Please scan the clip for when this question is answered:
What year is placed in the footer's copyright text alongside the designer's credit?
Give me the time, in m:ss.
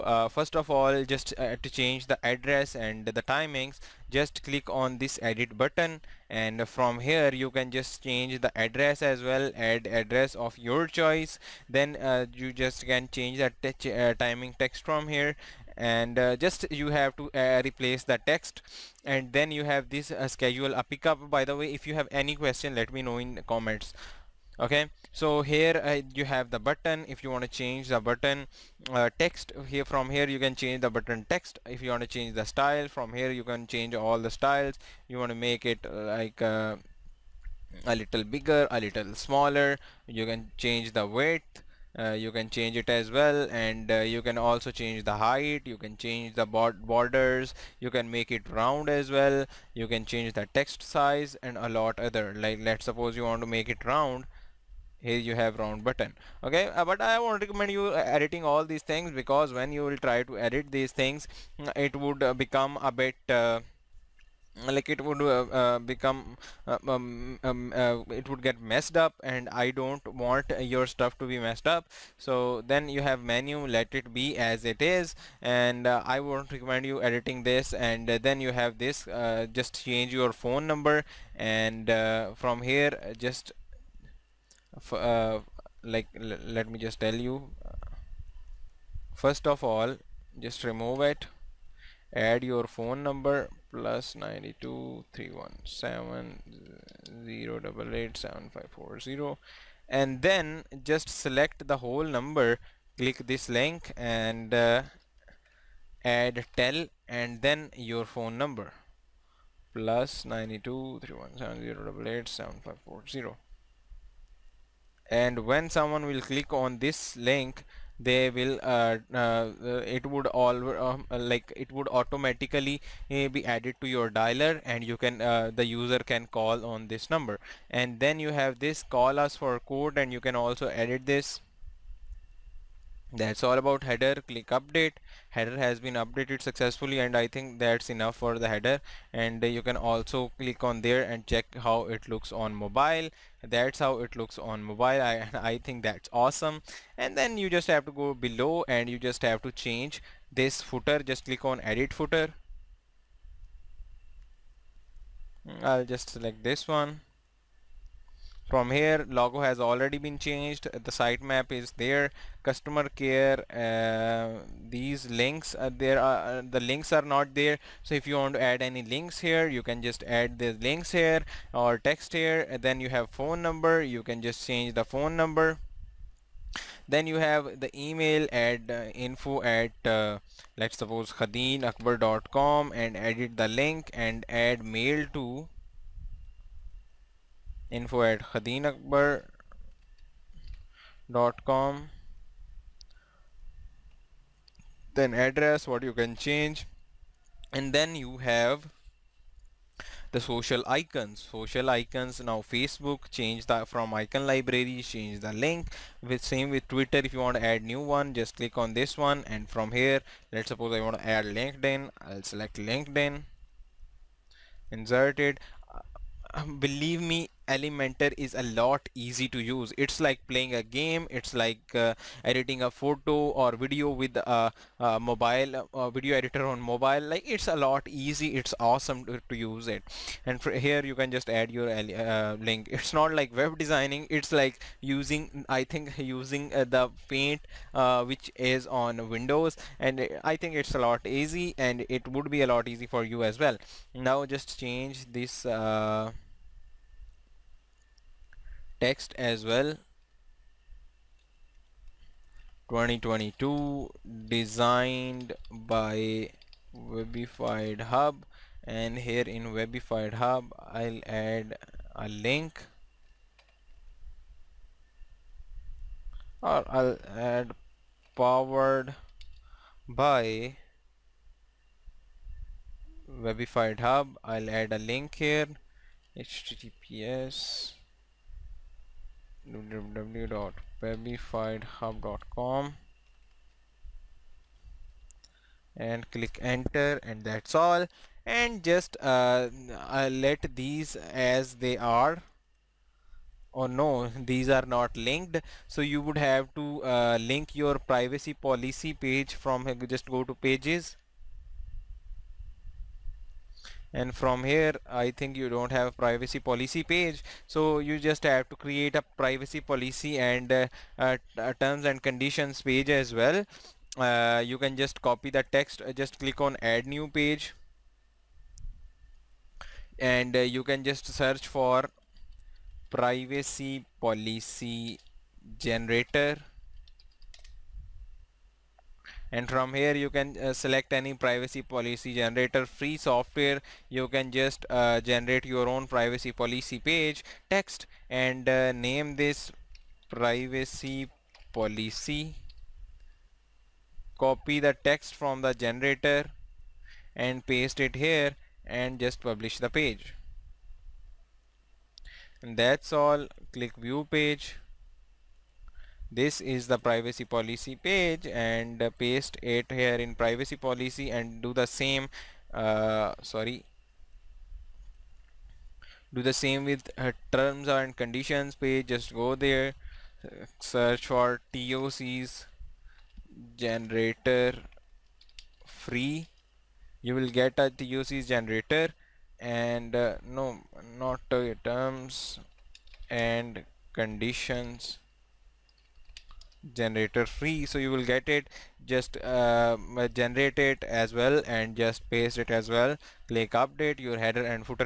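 4:12.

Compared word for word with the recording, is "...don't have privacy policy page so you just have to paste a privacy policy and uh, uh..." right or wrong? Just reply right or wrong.
wrong.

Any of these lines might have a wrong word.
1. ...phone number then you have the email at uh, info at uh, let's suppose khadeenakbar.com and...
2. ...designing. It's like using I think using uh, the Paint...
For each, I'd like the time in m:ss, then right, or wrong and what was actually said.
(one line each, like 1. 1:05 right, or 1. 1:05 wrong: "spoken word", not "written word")
1. 2:54 right
2. 3:53 right.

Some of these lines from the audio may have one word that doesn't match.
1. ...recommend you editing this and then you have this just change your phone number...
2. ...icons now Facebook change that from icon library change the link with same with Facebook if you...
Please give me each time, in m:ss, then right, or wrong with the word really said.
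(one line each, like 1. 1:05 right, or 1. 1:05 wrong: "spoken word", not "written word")
1. 1:16 right
2. 3:21 wrong: "Twitter", not "Facebook".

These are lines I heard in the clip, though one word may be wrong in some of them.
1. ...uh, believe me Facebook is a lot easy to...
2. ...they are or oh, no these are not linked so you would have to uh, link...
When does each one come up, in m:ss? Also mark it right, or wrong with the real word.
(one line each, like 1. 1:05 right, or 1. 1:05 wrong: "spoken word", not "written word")
1. 3:36 wrong: "Elementor", not "Facebook"
2. 4:51 right.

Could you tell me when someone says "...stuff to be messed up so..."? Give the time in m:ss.
1:10.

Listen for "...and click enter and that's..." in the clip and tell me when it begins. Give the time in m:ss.
4:45.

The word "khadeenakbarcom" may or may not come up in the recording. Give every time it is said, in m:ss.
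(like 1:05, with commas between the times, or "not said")
3:01, 3:08.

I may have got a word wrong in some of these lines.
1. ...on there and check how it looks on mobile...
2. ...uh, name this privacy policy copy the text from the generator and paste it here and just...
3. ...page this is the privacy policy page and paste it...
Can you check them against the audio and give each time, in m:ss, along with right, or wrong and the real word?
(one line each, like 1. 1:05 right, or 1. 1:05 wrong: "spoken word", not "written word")
1. 2:20 right
2. 5:38 right
3. 5:54 right.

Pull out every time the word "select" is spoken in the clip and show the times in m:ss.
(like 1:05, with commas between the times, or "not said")
1:41, 2:36, 3:32, 5:30.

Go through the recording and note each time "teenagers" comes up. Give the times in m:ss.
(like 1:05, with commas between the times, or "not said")
not said.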